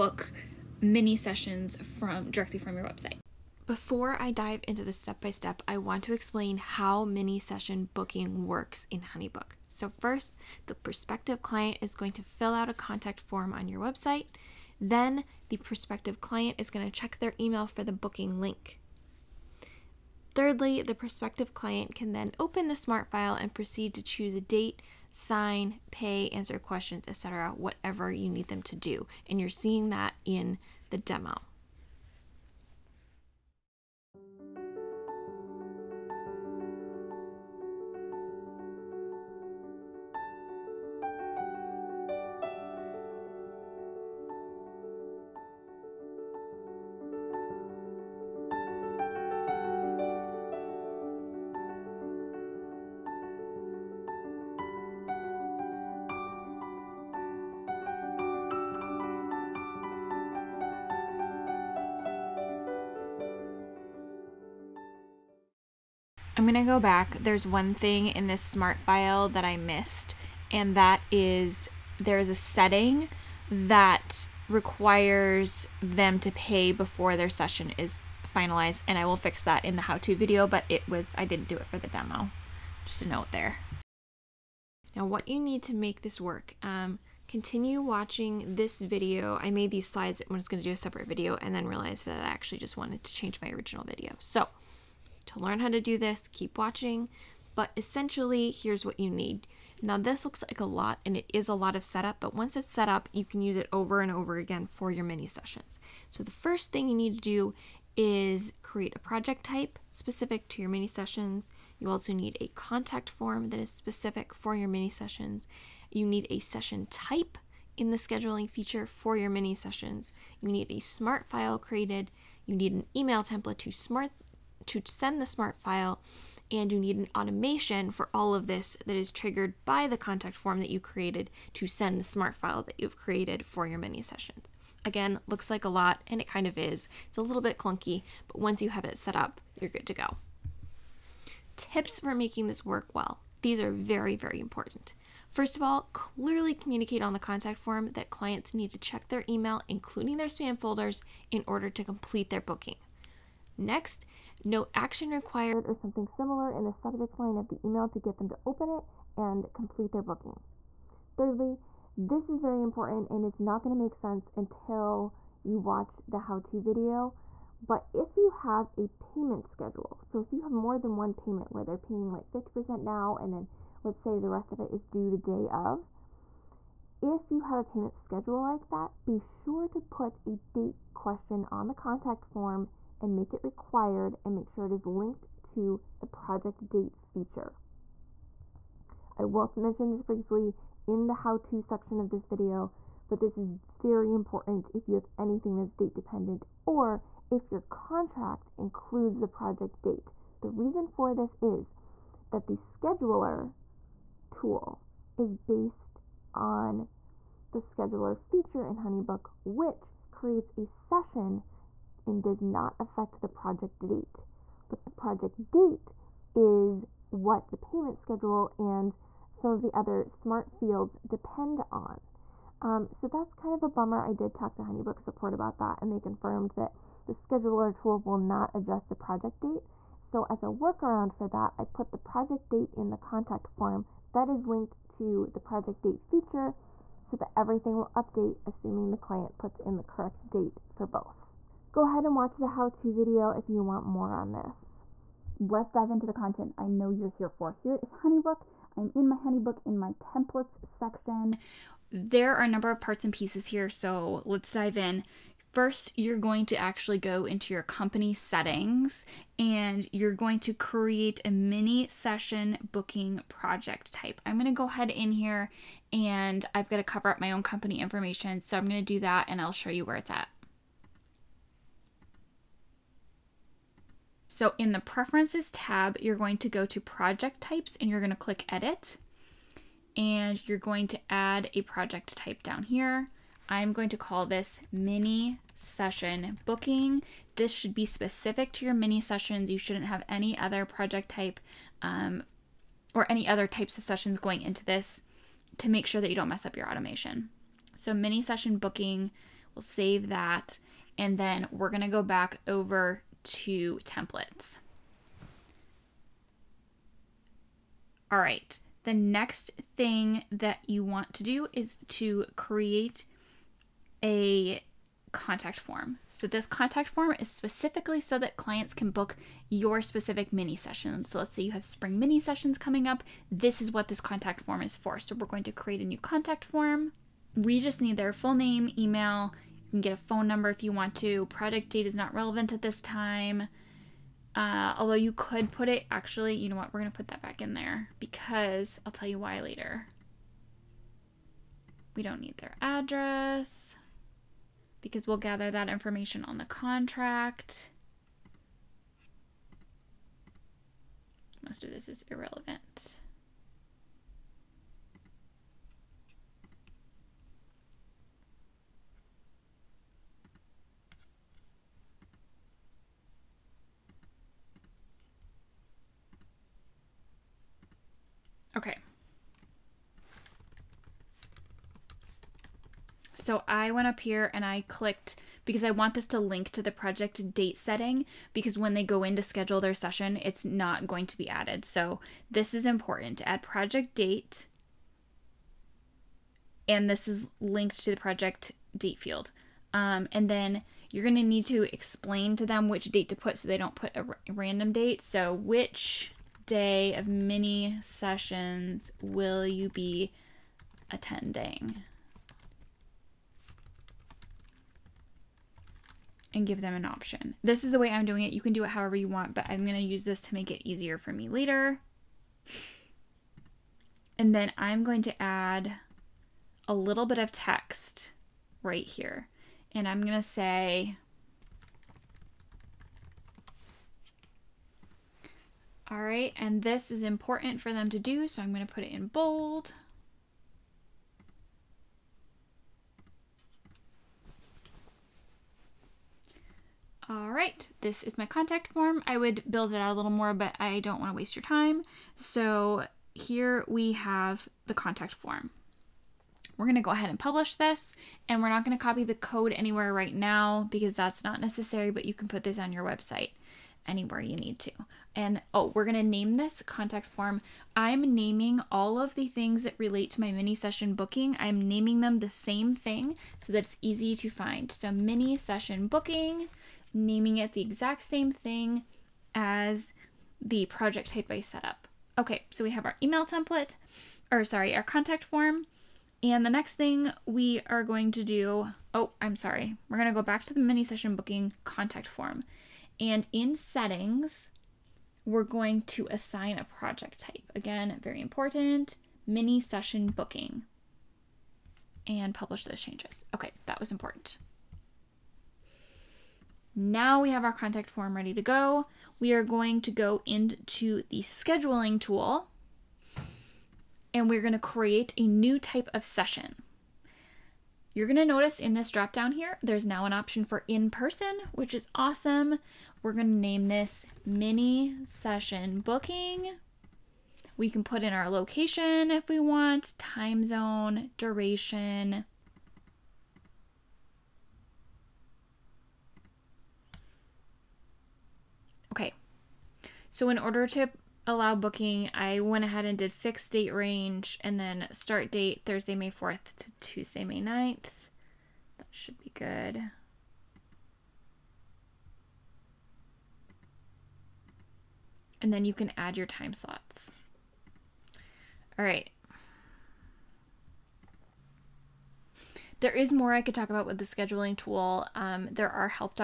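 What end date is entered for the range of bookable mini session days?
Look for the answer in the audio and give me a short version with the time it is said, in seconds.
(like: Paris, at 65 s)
Tuesday, May 9th, at 536 s.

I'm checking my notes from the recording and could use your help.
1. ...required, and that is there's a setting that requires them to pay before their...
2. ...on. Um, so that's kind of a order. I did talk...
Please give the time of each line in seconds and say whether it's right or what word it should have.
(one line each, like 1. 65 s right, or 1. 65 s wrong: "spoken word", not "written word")
1. 69 s wrong: "missed", not "required"
2. 221 s wrong: "bummer", not "order".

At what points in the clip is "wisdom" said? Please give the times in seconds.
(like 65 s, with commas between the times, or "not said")
not said.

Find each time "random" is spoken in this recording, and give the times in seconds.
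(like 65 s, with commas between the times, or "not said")
394 s.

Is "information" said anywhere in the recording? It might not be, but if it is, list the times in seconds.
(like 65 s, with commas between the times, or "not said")
267 s, 345 s.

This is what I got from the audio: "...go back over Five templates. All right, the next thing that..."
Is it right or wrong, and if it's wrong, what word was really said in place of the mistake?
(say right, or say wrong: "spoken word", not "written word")
wrong: "Two", not "Five".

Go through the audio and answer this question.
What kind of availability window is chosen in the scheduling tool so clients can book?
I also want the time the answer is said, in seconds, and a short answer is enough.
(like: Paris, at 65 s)
fixed date range, at 533 s.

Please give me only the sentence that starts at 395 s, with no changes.
So which day of mini sessions will you be attending?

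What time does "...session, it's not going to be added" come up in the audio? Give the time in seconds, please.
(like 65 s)
379 s.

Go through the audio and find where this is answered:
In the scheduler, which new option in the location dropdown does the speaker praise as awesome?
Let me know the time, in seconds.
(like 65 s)
510 s.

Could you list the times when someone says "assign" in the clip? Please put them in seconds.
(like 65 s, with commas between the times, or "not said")
486 s.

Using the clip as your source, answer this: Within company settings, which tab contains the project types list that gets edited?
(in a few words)
preferences.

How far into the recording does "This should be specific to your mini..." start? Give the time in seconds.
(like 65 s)
287 s.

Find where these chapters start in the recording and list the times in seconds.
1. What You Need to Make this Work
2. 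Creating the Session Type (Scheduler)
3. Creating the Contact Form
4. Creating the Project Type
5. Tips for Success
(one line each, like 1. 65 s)
1. 86 s
2. 501 s
3. 307 s
4. 253 s
5. 141 s.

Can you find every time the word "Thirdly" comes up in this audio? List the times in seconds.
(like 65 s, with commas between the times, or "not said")
20 s, 161 s.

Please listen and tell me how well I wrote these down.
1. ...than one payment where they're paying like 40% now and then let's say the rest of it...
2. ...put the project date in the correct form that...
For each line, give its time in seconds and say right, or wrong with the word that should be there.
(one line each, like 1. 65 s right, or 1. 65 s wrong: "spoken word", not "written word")
1. 170 s wrong: "50", not "40"
2. 231 s wrong: "contact", not "correct".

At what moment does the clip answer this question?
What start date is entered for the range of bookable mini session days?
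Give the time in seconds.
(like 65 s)
535 s.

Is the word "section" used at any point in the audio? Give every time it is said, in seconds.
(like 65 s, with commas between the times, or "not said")
191 s, 250 s.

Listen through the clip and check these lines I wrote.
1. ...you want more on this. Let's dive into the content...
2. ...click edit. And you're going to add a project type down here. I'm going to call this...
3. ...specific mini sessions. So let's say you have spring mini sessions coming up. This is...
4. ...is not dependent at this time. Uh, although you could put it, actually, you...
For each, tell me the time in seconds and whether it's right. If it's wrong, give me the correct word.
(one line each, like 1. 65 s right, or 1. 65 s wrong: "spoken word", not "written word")
1. 243 s right
2. 278 s right
3. 319 s right
4. 331 s wrong: "relevant", not "dependent".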